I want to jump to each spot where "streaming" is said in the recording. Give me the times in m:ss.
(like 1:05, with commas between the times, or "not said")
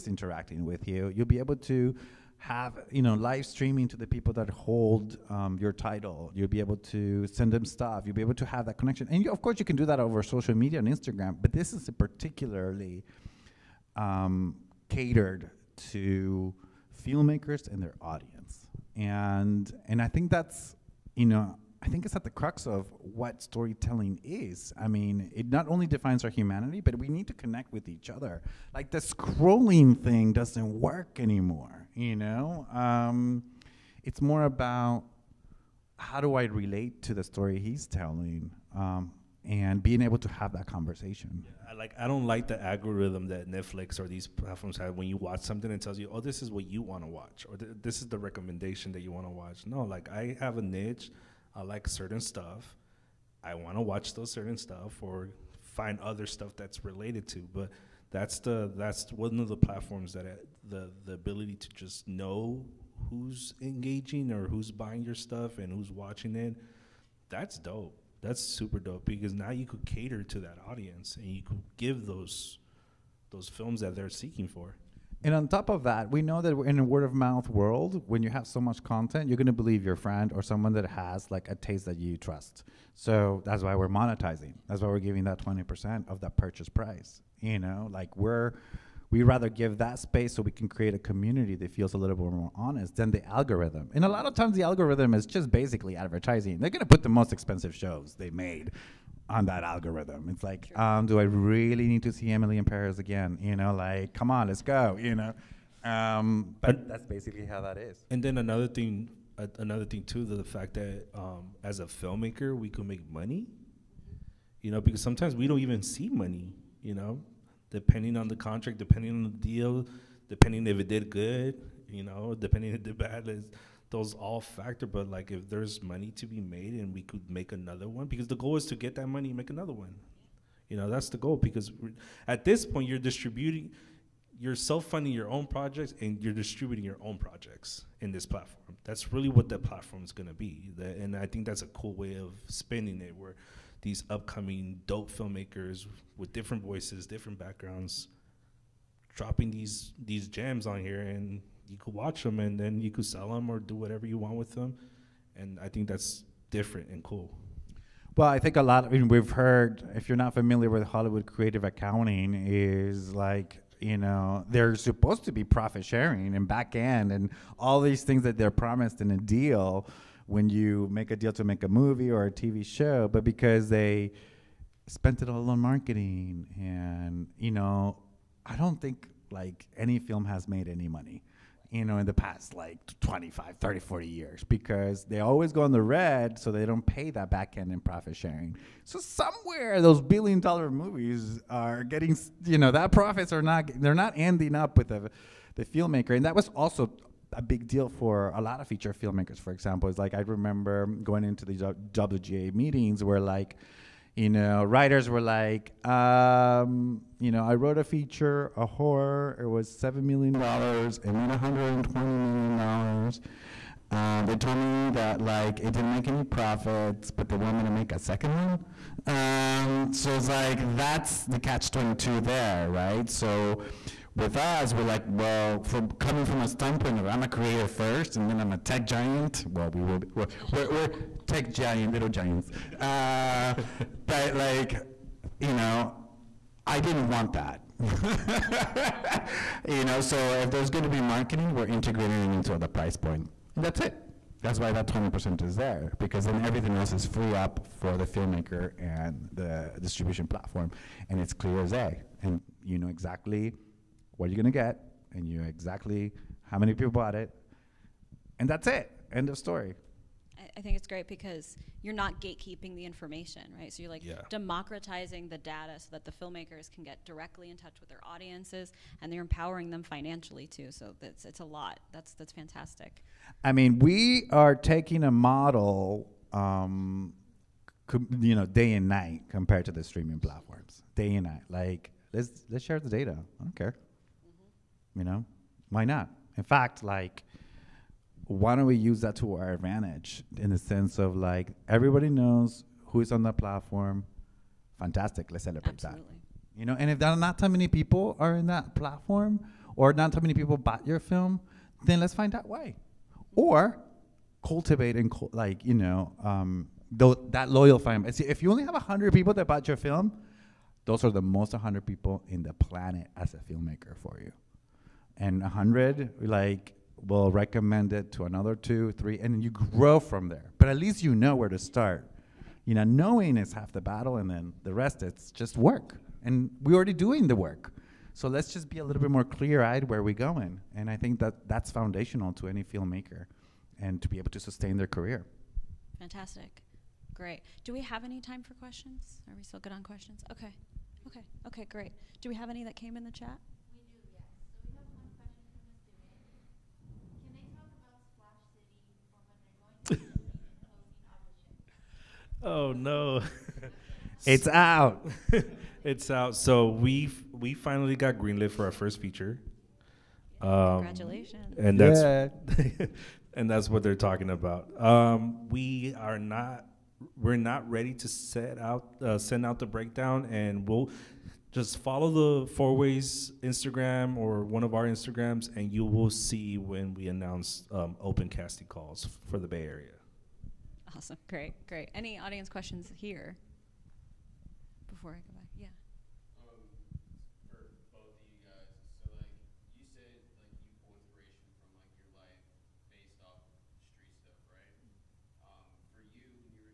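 0:03, 4:39.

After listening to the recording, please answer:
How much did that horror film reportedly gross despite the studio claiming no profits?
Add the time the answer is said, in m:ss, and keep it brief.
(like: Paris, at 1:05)
$120 million, at 3:31.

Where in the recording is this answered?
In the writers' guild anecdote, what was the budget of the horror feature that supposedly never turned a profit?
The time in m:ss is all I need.
3:29.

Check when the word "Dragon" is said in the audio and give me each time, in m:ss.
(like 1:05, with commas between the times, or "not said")
not said.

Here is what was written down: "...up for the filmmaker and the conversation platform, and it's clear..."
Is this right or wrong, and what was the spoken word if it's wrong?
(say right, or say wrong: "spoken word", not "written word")
wrong: "distribution", not "conversation".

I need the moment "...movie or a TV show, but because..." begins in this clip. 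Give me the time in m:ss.
2:51.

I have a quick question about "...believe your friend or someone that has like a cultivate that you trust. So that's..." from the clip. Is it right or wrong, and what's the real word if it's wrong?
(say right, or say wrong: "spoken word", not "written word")
wrong: "taste", not "cultivate".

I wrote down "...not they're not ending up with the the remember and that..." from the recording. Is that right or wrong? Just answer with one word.
wrong.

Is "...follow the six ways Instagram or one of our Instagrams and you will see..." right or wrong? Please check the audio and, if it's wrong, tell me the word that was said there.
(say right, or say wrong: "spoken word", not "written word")
wrong: "four", not "six".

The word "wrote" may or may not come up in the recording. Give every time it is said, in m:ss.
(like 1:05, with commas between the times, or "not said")
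3:27.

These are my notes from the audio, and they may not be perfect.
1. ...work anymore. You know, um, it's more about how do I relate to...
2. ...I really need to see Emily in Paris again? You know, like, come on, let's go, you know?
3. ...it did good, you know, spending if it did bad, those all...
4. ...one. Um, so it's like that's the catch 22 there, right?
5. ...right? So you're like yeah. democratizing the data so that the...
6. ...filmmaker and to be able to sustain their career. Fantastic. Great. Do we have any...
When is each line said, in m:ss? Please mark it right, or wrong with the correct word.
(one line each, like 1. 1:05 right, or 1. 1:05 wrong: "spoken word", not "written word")
1. 0:30 right
2. 1:41 right
3. 2:00 wrong: "depending", not "spending"
4. 3:38 right
5. 4:23 right
6. 5:32 right.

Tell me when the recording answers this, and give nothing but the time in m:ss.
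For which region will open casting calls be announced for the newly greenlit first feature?
6:19.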